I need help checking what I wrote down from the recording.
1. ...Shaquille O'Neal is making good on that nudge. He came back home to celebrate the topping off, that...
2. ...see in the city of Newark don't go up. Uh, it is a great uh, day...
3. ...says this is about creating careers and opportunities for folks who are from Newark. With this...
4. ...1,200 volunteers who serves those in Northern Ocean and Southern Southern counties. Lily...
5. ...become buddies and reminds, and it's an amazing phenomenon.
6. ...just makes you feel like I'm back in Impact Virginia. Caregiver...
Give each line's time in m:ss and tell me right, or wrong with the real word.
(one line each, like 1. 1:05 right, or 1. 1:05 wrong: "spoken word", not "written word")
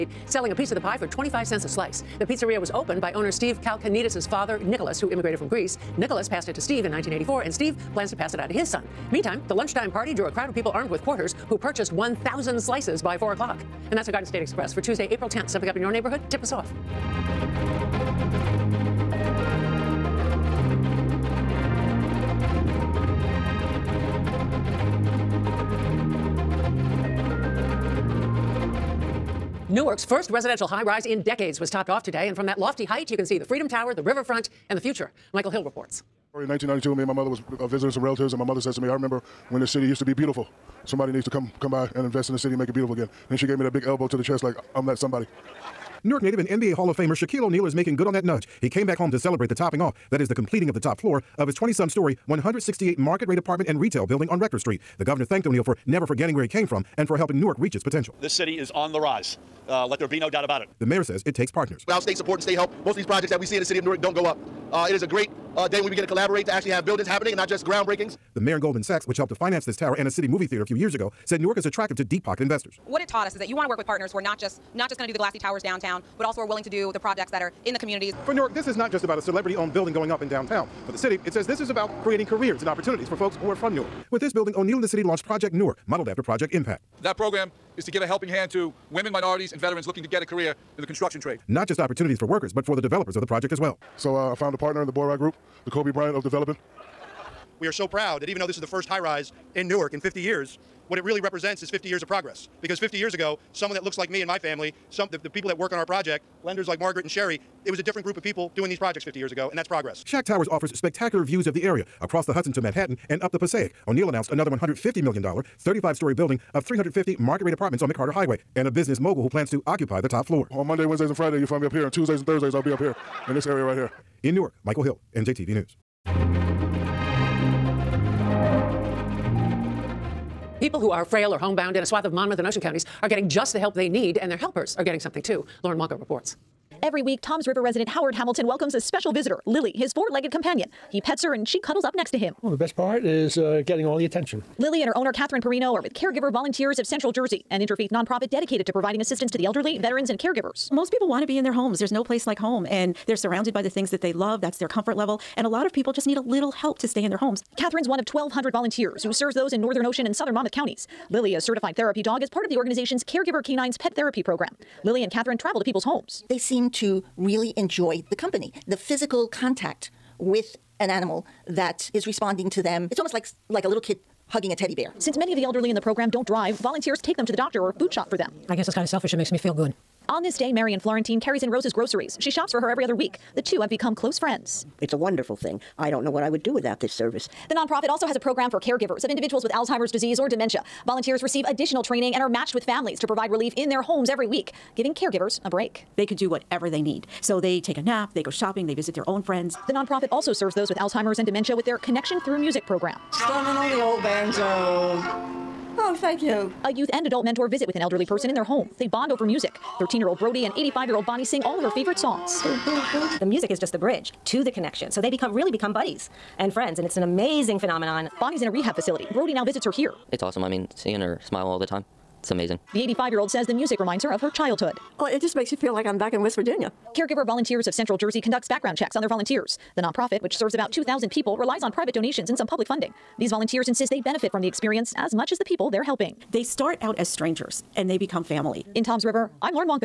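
1. 0:47 right
2. 1:03 right
3. 1:21 right
4. 2:38 wrong: "Monmouth", not "Southern"
5. 3:35 wrong: "friends", not "reminds"
6. 3:45 wrong: "West", not "Impact".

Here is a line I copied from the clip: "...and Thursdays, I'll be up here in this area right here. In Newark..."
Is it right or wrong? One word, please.
right.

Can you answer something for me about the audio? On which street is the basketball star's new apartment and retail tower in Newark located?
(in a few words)
Rector Street.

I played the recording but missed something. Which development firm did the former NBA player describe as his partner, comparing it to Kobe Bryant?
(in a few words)
Boraie Group.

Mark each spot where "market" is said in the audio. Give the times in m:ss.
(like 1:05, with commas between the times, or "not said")
0:52, 1:57.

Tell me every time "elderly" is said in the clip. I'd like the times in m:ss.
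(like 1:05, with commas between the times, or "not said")
2:29, 2:55, 3:27.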